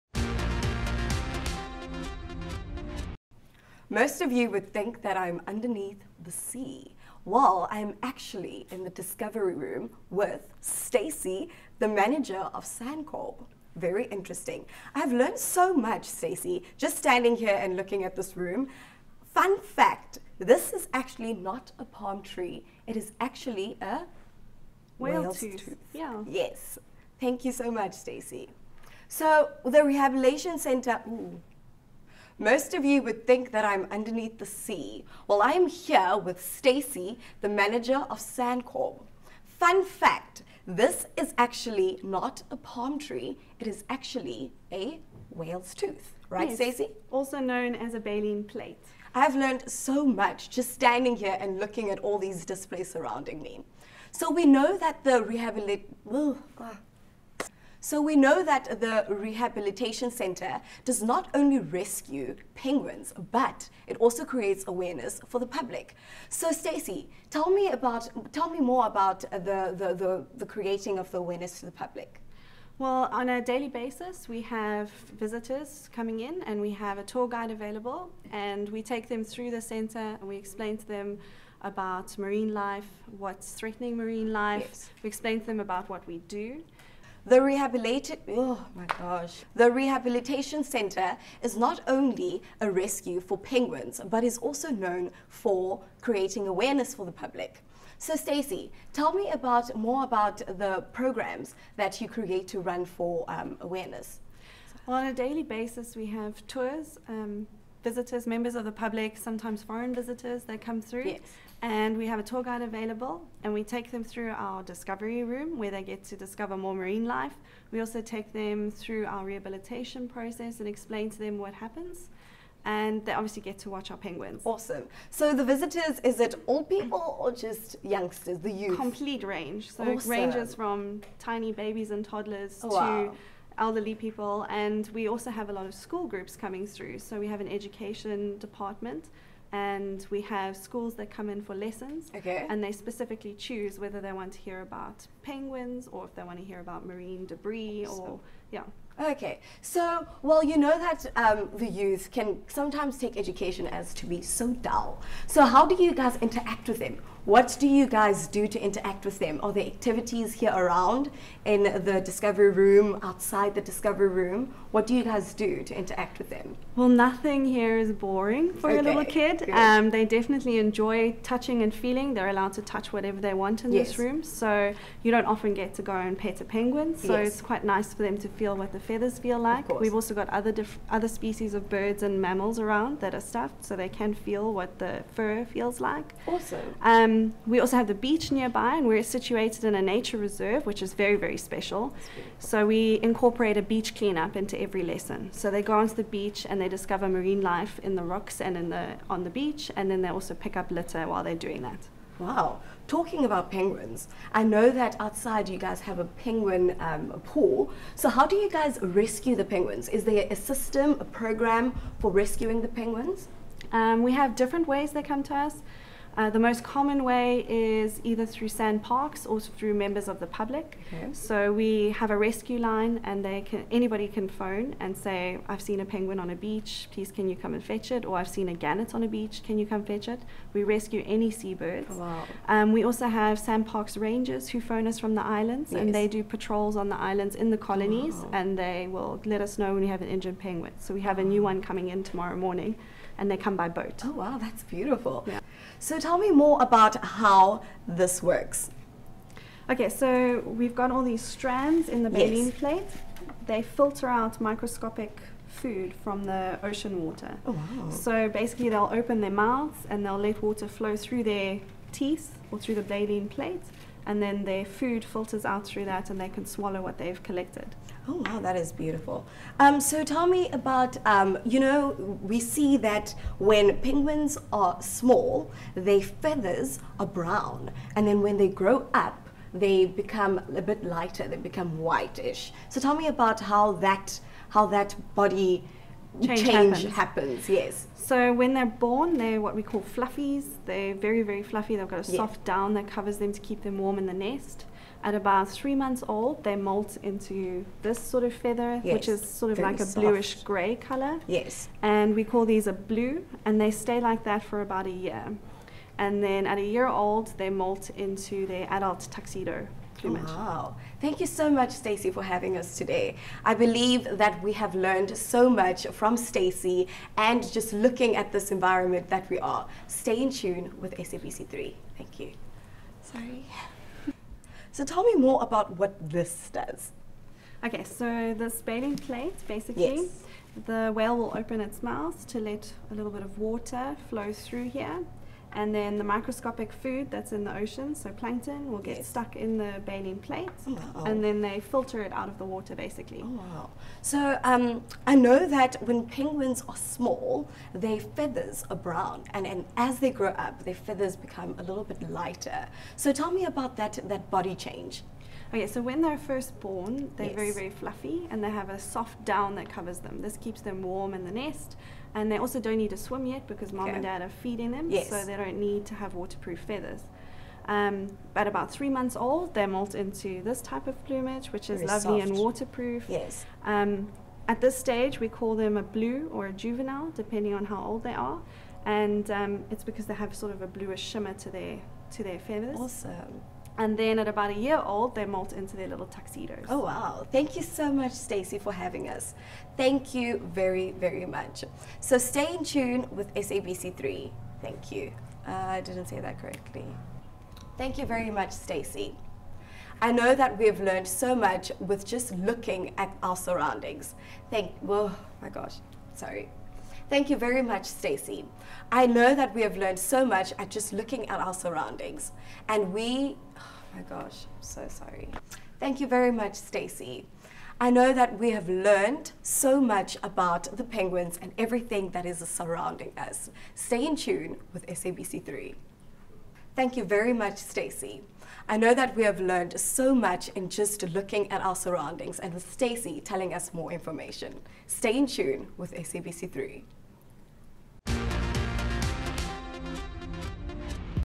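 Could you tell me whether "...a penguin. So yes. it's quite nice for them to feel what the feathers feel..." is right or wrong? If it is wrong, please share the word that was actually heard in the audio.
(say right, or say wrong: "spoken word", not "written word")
right.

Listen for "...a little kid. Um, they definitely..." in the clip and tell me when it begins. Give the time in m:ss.
2:48.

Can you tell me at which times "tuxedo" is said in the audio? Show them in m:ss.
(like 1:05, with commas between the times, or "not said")
5:09, 6:26.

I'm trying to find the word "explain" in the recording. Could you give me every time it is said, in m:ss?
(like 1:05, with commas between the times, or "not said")
1:20, 1:25, 2:00.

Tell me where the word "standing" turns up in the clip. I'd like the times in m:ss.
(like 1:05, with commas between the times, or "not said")
0:16, 0:50.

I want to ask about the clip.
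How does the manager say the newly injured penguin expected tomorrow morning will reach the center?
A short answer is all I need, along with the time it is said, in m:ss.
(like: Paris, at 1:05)
by boat, at 4:03.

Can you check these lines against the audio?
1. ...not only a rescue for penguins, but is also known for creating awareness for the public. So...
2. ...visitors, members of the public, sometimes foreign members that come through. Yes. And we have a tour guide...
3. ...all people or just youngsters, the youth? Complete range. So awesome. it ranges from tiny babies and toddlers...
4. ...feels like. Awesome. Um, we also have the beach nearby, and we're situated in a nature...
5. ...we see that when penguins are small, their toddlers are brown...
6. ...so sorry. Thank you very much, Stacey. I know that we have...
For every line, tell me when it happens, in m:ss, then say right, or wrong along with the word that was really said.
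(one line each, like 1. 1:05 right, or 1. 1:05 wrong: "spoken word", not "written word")
1. 1:31 right
2. 1:47 wrong: "visitors", not "members"
3. 2:06 right
4. 3:05 right
5. 4:32 wrong: "feathers", not "toddlers"
6. 6:54 right.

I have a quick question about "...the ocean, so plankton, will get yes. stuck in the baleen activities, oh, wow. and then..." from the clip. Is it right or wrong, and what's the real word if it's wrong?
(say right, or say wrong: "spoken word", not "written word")
wrong: "plates", not "activities".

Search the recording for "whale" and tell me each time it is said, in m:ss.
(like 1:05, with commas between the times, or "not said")
0:24, 0:45, 5:30.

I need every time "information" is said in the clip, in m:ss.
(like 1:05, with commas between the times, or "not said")
7:13.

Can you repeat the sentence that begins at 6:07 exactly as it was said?
Um, at about three months old, they molt into this type of plumage, which is very lovely soft.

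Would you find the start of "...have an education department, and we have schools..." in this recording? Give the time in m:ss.
2:17.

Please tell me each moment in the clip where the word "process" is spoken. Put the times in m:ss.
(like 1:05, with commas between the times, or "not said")
2:00.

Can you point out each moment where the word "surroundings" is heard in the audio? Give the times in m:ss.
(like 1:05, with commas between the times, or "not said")
0:52, 6:43, 6:51, 7:02, 7:11.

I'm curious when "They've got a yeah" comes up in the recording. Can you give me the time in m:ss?
4:51.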